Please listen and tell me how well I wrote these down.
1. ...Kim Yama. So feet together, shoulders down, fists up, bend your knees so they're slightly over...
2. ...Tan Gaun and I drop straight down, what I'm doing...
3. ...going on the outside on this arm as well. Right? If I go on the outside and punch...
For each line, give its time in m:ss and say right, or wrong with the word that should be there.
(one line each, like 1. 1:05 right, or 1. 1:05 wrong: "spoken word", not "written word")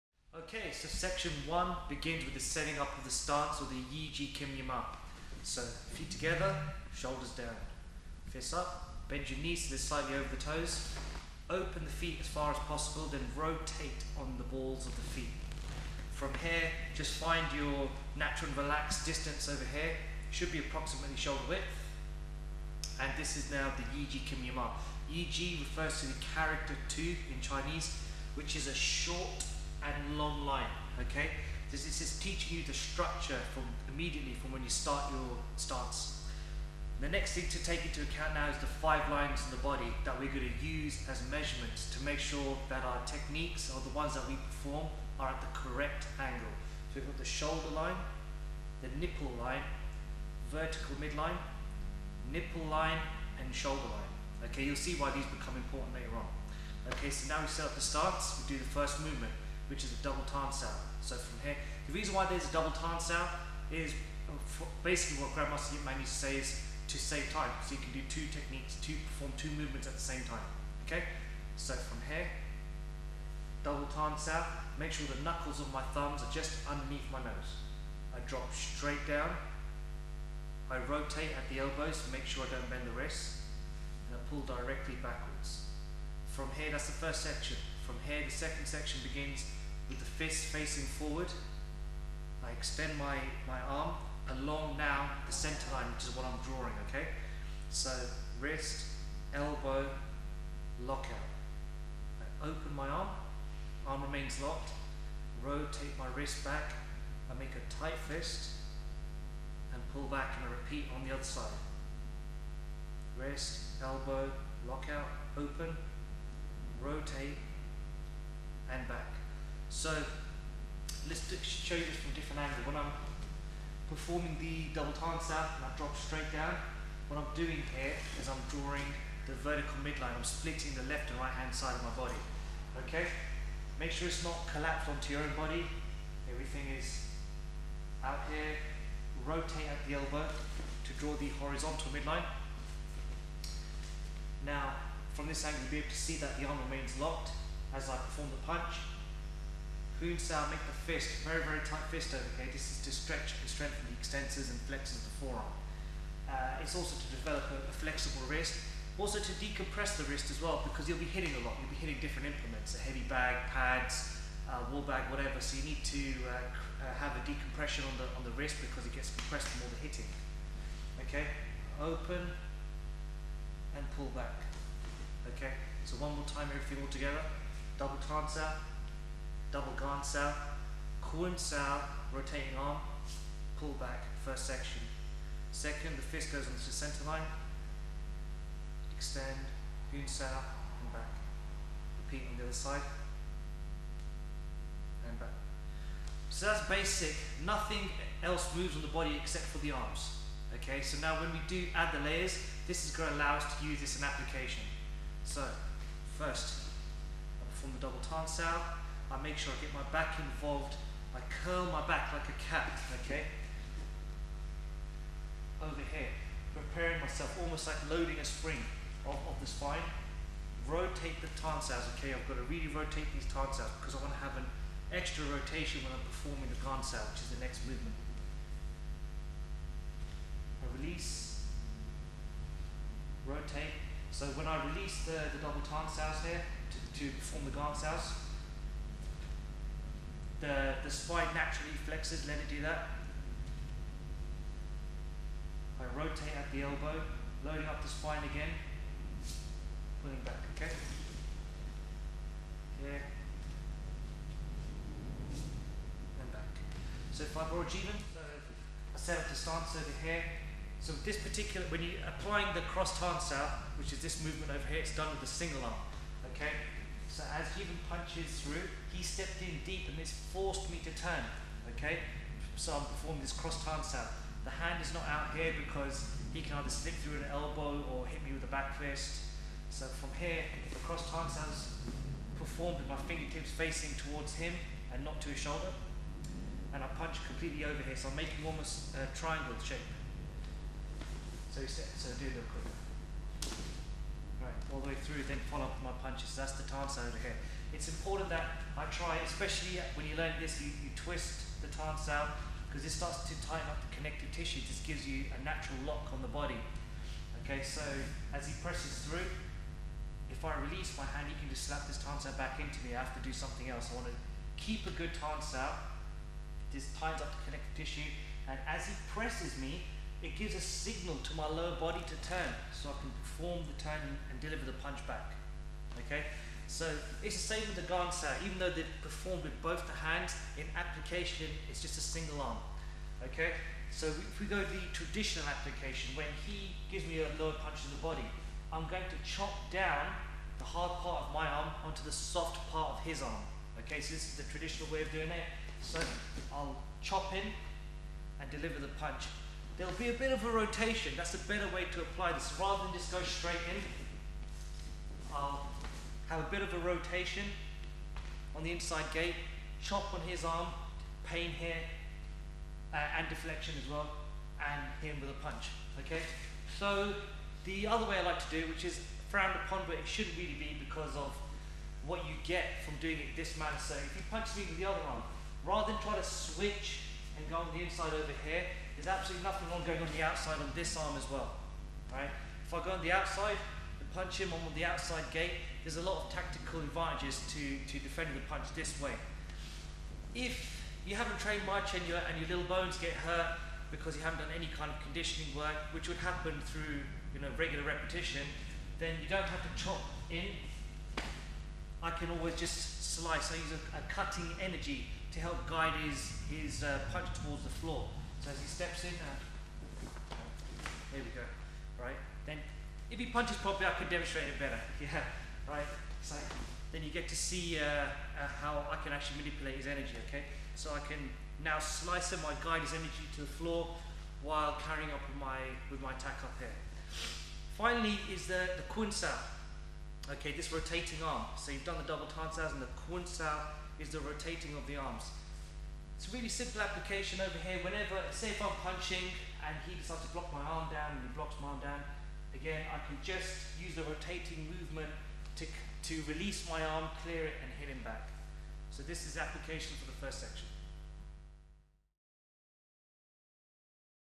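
1. 0:04 right
2. 2:04 wrong: "Sao", not "Gaun"
3. 6:19 right.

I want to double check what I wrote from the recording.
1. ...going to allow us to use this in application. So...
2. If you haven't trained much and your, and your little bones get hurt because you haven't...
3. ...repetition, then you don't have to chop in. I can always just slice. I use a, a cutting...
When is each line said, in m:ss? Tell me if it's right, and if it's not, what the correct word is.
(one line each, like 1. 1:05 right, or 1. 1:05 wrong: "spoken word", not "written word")
1. 3:22 right
2. 6:30 right
3. 6:37 right.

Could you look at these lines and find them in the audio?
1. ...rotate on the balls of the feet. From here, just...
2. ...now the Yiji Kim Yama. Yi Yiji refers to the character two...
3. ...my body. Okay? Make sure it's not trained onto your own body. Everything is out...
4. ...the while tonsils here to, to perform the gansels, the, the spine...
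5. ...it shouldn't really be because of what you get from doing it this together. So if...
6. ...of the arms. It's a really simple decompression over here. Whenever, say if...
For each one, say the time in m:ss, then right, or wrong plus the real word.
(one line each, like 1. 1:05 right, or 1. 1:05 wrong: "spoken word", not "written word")
1. 0:13 right
2. 0:23 right
3. 2:11 wrong: "collapsed", not "trained"
4. 3:55 wrong: "double", not "while"
5. 6:09 wrong: "manner", not "together"
6. 7:14 wrong: "application", not "decompression".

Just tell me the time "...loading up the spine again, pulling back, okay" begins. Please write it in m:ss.
4:07.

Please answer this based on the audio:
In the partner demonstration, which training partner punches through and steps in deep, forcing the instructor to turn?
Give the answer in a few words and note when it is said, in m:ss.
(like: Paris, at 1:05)
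Jeevan, at 4:27.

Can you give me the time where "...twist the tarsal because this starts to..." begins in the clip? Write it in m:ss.
5:00.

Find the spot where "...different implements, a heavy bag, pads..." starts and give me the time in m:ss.
2:42.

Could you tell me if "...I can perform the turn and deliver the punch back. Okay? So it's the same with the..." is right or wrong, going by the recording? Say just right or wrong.
right.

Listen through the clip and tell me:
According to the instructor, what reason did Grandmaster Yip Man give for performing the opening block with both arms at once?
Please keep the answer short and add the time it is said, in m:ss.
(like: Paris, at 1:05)
to save time, at 1:06.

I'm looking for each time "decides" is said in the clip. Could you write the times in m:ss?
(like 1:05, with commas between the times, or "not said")
7:19.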